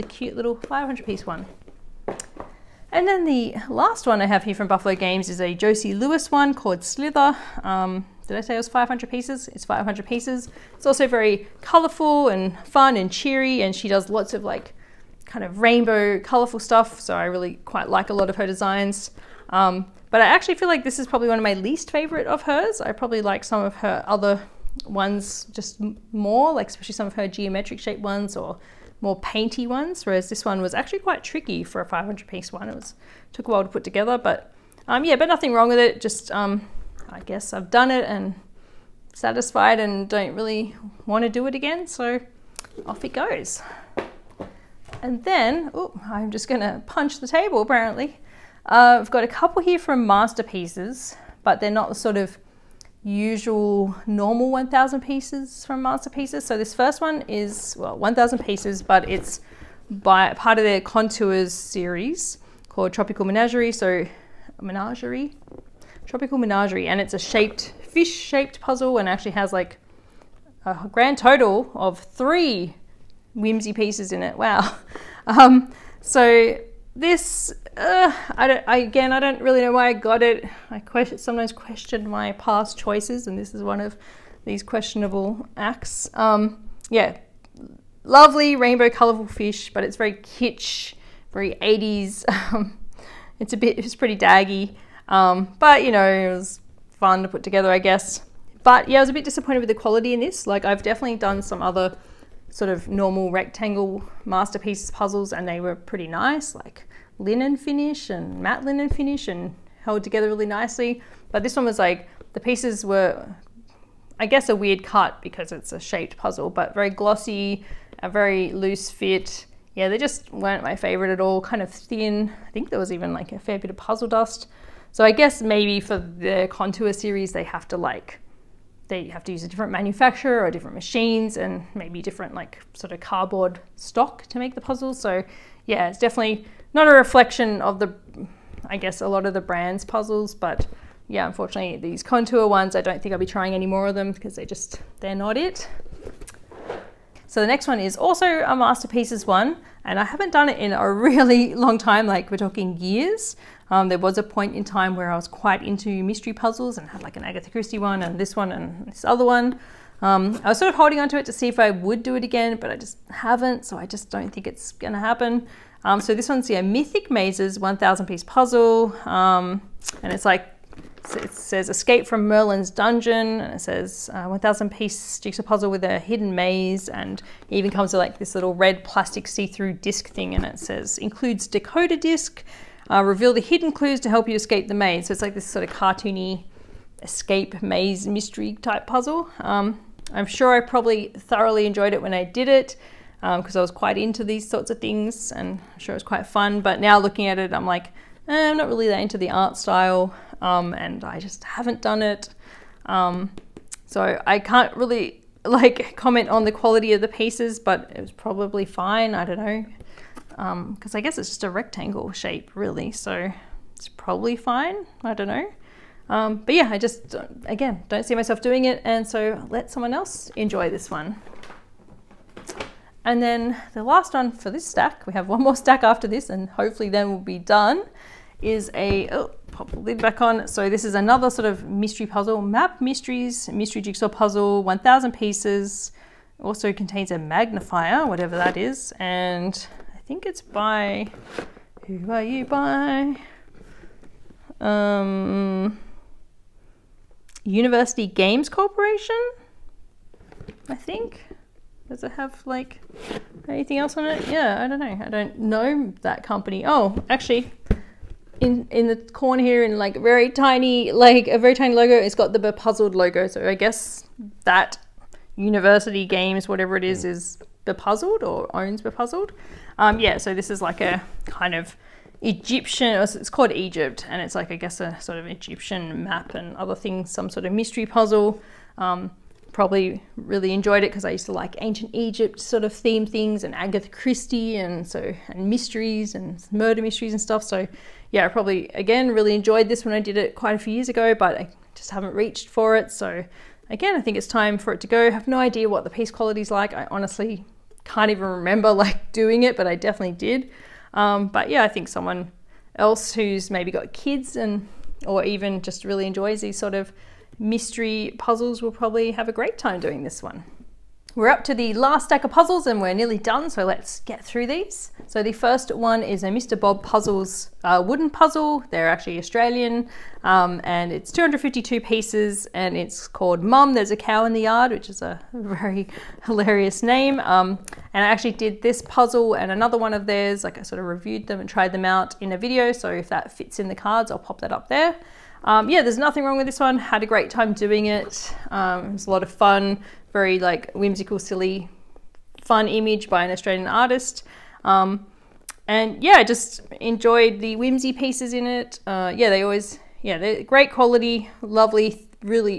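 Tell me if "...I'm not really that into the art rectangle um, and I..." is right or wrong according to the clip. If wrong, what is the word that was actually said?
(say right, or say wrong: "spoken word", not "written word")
wrong: "style", not "rectangle".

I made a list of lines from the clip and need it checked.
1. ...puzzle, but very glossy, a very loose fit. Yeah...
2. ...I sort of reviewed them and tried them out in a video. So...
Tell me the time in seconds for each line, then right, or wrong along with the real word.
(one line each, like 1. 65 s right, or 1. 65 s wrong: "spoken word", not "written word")
1. 116 s right
2. 330 s right.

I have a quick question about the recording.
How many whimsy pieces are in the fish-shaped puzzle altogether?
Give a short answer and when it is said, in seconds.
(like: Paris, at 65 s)
3, at 71 s.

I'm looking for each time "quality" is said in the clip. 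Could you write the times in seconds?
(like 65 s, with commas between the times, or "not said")
99 s, 206 s, 296 s, 350 s.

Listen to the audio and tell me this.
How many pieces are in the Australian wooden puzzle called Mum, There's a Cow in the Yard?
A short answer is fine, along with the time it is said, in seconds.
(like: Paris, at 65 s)
252, at 321 s.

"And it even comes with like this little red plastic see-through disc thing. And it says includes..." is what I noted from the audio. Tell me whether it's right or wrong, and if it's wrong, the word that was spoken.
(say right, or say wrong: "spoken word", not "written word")
right.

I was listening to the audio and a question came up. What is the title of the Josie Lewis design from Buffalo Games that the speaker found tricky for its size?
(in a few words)
Slither.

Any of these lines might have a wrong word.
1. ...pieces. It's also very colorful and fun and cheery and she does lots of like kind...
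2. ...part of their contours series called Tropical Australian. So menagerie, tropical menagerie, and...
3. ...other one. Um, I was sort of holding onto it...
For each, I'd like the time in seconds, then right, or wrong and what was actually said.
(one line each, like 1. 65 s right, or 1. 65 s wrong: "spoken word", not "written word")
1. 10 s right
2. 60 s wrong: "Menagerie", not "Australian"
3. 159 s right.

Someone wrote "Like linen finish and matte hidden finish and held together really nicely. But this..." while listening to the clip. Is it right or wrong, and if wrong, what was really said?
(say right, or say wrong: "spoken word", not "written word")
wrong: "linen", not "hidden".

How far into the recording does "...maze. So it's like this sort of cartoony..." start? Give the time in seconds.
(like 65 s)
184 s.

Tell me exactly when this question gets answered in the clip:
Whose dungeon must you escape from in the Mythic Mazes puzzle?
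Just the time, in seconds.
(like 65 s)
172 s.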